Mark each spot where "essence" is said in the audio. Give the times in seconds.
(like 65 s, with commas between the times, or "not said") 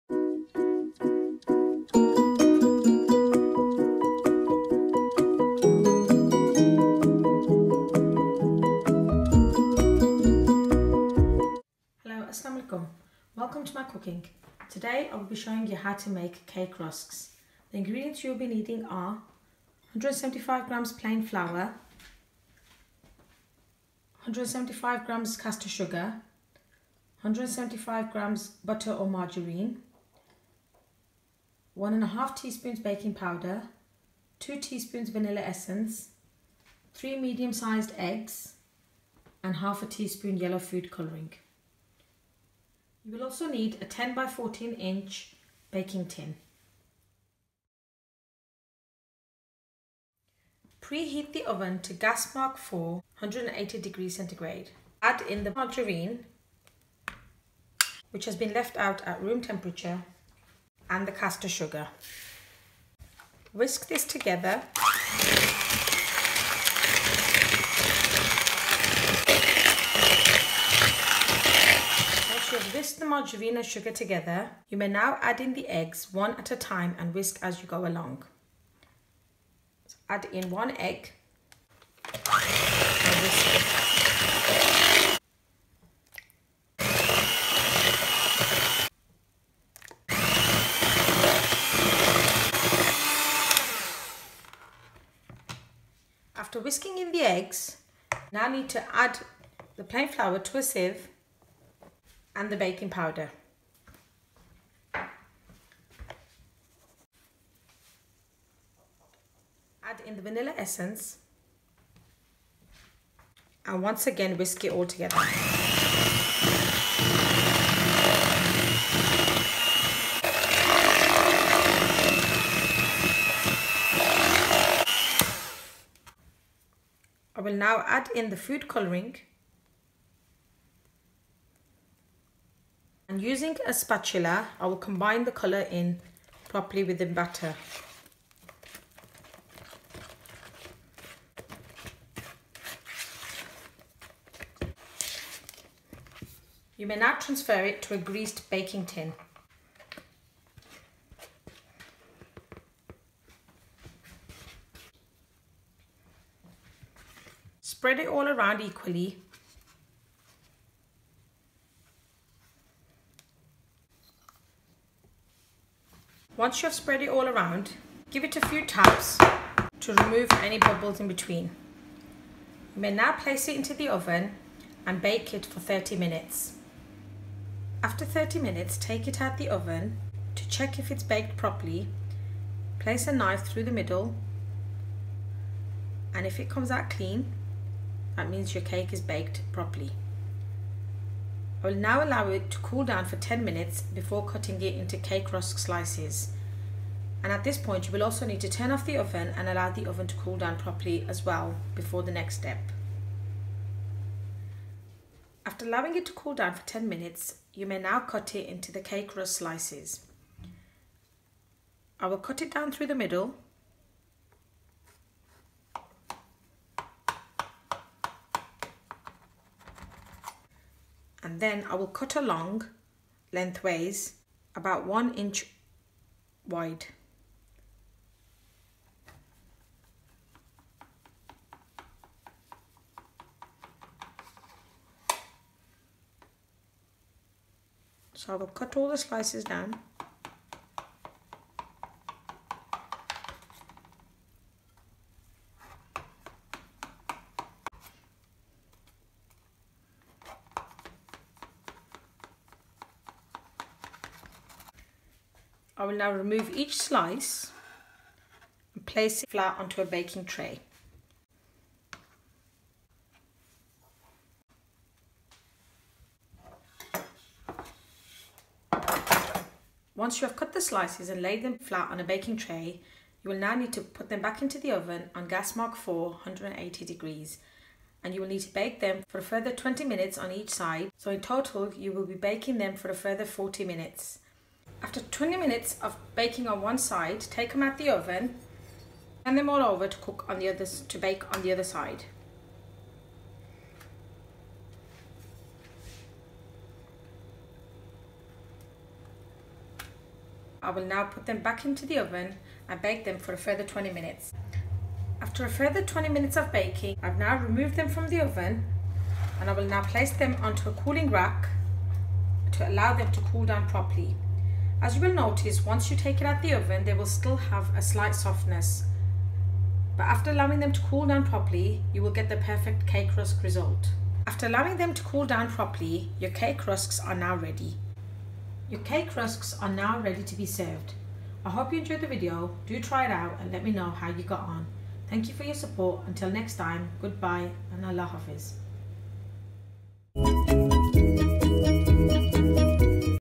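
35 s, 110 s.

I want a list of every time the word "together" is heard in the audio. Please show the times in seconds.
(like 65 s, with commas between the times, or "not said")
64 s, 73 s, 114 s.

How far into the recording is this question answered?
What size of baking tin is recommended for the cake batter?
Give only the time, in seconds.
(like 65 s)
43 s.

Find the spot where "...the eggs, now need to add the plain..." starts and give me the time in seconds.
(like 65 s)
97 s.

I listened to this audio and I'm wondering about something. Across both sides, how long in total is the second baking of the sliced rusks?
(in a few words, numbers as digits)
40 minutes.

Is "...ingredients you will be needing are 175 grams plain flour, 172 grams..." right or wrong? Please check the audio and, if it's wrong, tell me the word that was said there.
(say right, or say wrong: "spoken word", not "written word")
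wrong: "175", not "172".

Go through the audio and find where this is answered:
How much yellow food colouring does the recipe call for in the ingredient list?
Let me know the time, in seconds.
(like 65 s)
39 s.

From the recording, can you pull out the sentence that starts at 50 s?
Preheat the oven to gas mark 4, 180 degrees centigrade.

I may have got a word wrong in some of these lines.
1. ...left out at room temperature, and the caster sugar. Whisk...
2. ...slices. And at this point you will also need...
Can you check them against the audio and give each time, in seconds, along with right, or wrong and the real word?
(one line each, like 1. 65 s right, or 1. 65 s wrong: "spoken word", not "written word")
1. 58 s right
2. 195 s right.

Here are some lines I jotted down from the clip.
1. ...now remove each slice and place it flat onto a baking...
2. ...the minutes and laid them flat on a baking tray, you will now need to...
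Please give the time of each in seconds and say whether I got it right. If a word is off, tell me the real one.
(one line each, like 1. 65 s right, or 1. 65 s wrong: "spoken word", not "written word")
1. 255 s right
2. 270 s wrong: "slices", not "minutes".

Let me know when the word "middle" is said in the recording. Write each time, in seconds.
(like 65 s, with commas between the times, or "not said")
183 s, 212 s.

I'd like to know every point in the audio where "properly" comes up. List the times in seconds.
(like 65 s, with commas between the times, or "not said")
136 s, 181 s, 189 s, 200 s, 313 s, 321 s, 325 s.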